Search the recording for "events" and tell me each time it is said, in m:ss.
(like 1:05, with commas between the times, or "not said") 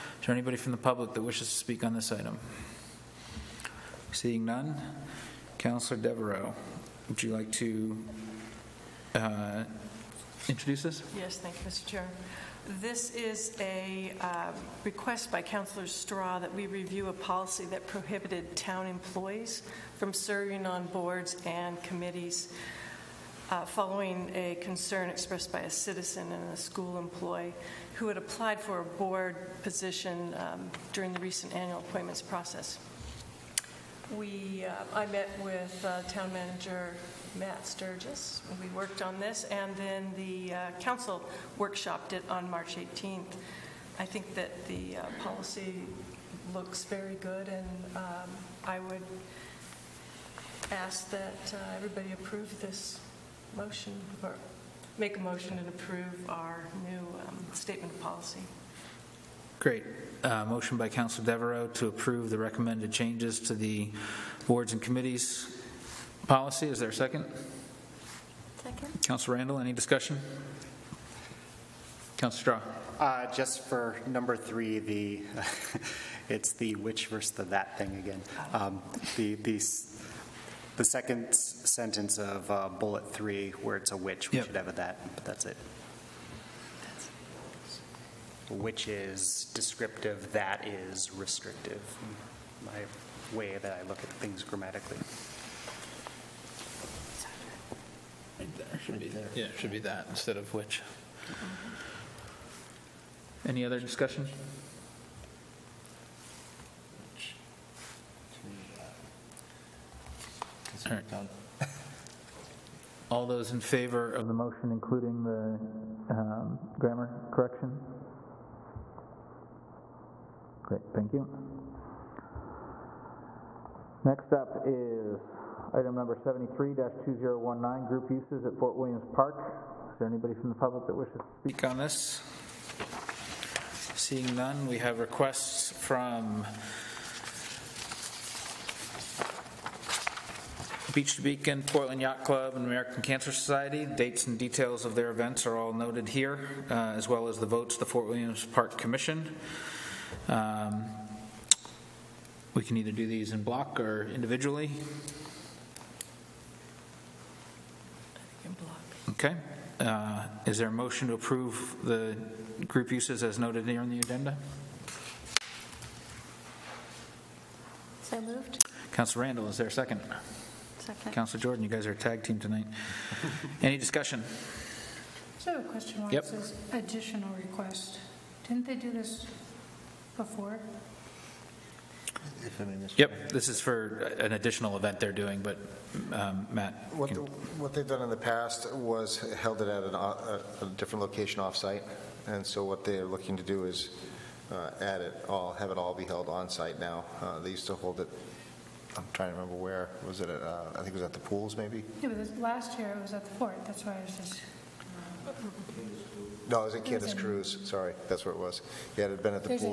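2:25, 3:04.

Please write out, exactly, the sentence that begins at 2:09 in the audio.
Is there anybody from the public that wishes to speak on this?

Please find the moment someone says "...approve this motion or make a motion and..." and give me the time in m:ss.
0:52.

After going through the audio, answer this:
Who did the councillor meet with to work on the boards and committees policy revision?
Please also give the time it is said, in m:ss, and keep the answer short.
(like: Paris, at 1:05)
Matt Sturgis, at 0:37.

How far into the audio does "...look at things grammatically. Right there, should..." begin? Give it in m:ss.
1:33.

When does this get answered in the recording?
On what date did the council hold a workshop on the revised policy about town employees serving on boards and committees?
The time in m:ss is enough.
0:42.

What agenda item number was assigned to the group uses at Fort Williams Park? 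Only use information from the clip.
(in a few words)
73-2019.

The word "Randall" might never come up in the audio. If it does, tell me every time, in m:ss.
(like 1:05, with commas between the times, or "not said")
1:09, 2:49.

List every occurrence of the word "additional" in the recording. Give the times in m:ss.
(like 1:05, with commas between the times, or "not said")
2:56, 3:04.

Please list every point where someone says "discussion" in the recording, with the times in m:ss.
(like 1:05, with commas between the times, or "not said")
1:09, 1:43, 2:53.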